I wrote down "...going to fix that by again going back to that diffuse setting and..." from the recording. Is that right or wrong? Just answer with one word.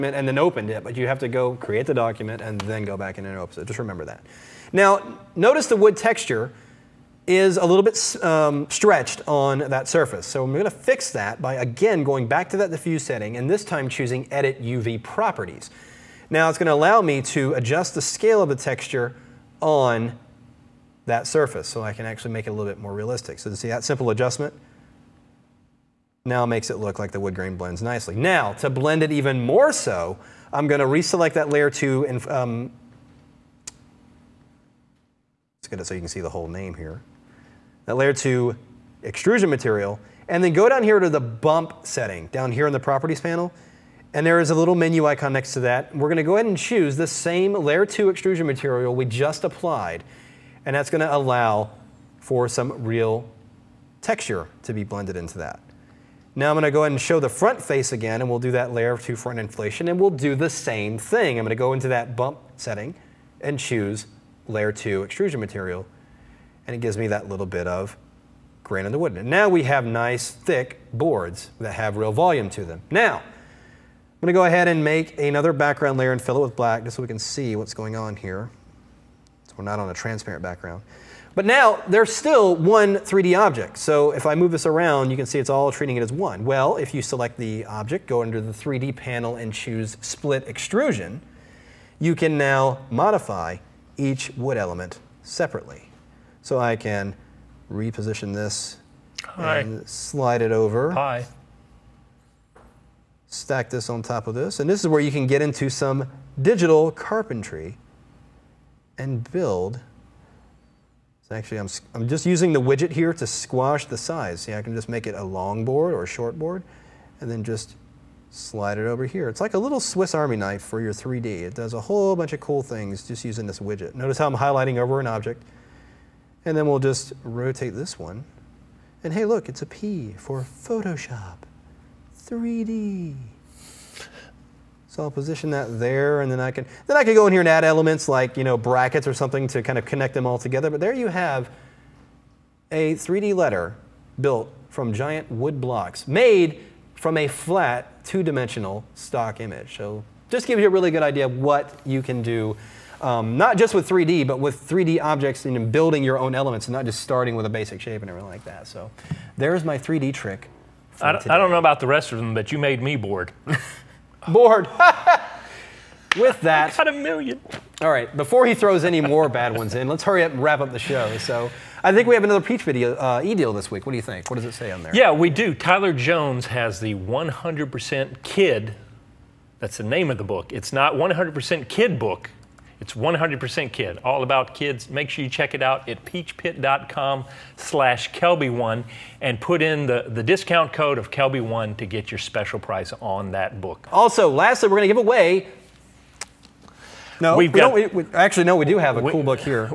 right.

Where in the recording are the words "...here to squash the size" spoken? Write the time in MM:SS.
01:52.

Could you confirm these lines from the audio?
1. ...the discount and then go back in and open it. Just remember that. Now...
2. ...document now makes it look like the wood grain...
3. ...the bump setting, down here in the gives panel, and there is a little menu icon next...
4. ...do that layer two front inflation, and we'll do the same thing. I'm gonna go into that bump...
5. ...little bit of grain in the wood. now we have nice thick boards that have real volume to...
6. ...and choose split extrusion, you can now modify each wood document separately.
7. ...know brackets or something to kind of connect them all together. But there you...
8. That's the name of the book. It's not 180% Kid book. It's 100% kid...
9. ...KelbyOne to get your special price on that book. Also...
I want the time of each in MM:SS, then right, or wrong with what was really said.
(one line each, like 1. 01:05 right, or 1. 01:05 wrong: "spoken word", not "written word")
1. 00:01 wrong: "document", not "discount"
2. 00:24 wrong: "adjustment", not "document"
3. 00:41 wrong: "properties", not "gives"
4. 00:58 right
5. 01:07 right
6. 01:29 wrong: "element", not "document"
7. 02:18 right
8. 02:59 wrong: "100", not "180"
9. 03:11 right.